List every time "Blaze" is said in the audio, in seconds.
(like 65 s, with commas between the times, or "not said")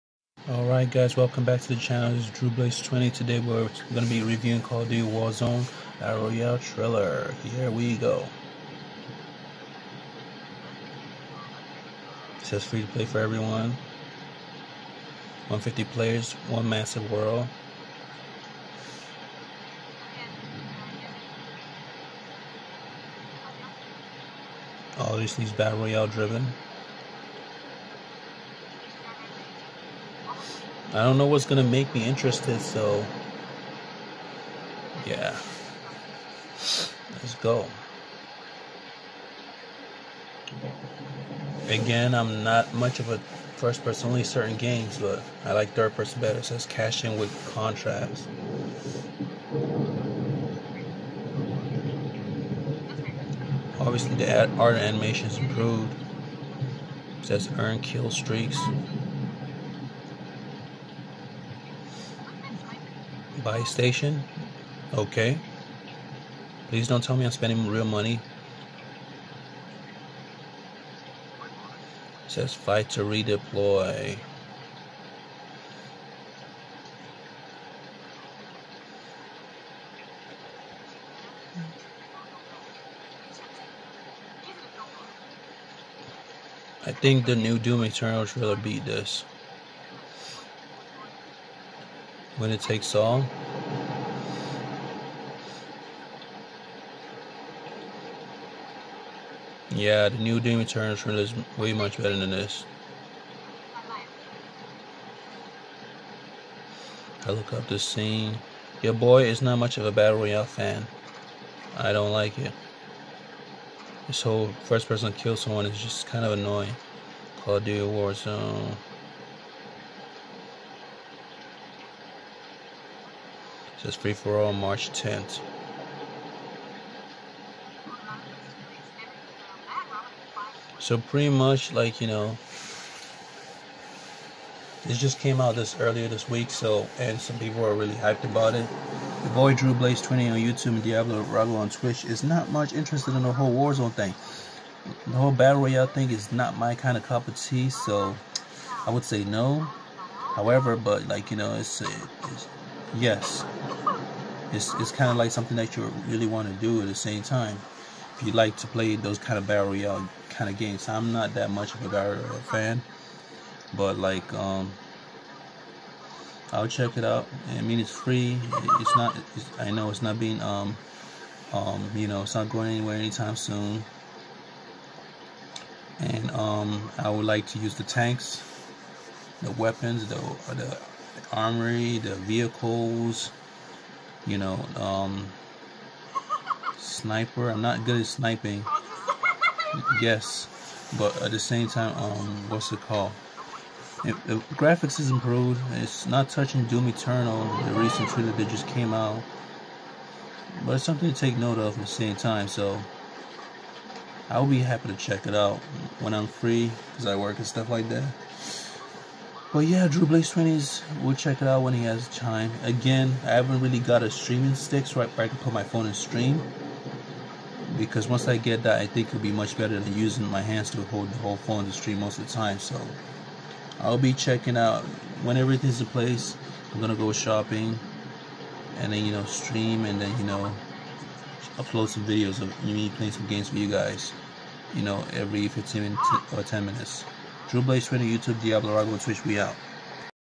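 2 s, 139 s, 210 s, 237 s.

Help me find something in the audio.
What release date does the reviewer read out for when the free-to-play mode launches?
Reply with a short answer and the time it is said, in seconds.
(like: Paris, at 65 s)
March 10th, at 124 s.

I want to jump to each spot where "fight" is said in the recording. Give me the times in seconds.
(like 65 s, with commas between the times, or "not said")
72 s.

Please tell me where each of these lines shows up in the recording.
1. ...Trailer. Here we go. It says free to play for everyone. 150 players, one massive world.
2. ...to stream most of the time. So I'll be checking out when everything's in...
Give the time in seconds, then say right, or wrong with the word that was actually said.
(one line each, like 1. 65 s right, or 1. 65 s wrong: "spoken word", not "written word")
1. 6 s right
2. 221 s right.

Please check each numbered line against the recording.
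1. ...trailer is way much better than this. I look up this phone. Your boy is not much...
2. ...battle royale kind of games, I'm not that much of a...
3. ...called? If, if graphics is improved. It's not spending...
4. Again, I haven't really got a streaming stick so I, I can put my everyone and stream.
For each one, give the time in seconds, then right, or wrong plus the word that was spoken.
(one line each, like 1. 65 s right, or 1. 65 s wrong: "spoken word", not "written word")
1. 100 s wrong: "scene", not "phone"
2. 159 s right
3. 192 s wrong: "touching", not "spending"
4. 212 s wrong: "phone", not "everyone".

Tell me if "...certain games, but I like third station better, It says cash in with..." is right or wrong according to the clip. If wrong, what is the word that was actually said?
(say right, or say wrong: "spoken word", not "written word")
wrong: "person", not "station".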